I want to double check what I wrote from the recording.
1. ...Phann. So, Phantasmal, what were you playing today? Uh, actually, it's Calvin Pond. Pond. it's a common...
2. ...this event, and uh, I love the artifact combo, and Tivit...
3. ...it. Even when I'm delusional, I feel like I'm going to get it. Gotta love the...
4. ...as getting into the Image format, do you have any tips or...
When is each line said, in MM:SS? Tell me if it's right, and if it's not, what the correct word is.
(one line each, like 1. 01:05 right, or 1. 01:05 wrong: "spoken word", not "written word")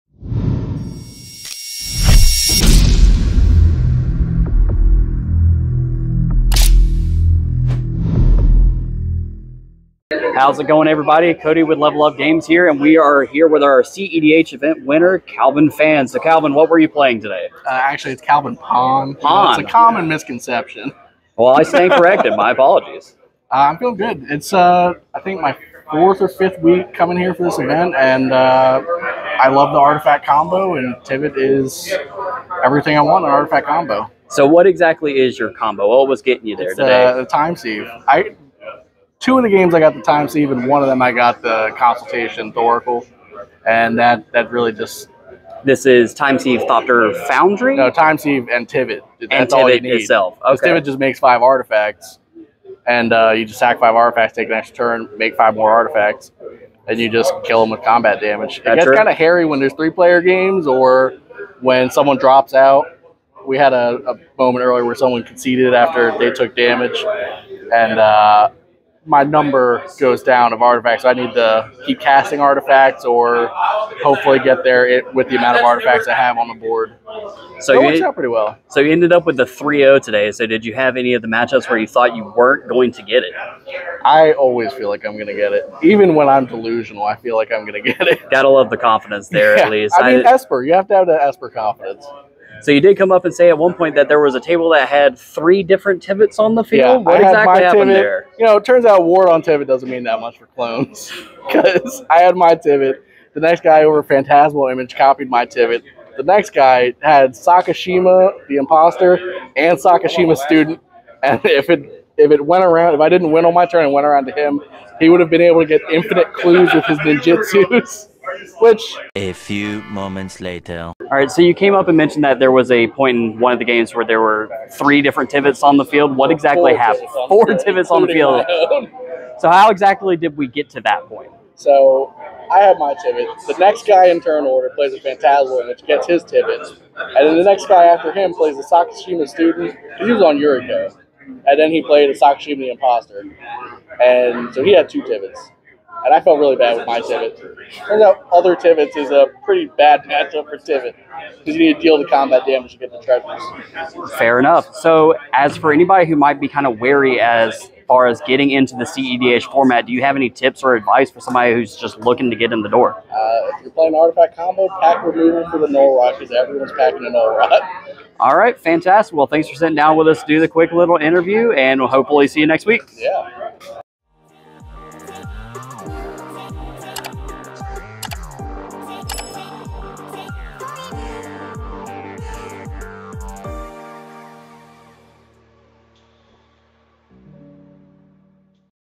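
1. 00:15 wrong: "Calvin", not "Phantasmal"
2. 00:27 right
3. 01:25 right
4. 02:38 wrong: "CEDH", not "Image".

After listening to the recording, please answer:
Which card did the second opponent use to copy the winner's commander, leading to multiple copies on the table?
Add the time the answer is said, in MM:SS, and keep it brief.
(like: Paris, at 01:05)
Phantasmal Image, at 01:44.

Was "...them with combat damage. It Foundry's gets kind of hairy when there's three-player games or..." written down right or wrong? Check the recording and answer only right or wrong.
wrong.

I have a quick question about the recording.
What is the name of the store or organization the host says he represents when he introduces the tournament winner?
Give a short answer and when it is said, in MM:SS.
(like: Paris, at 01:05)
Level Up Games, at 00:11.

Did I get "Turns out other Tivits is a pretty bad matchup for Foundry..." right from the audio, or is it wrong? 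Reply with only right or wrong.
wrong.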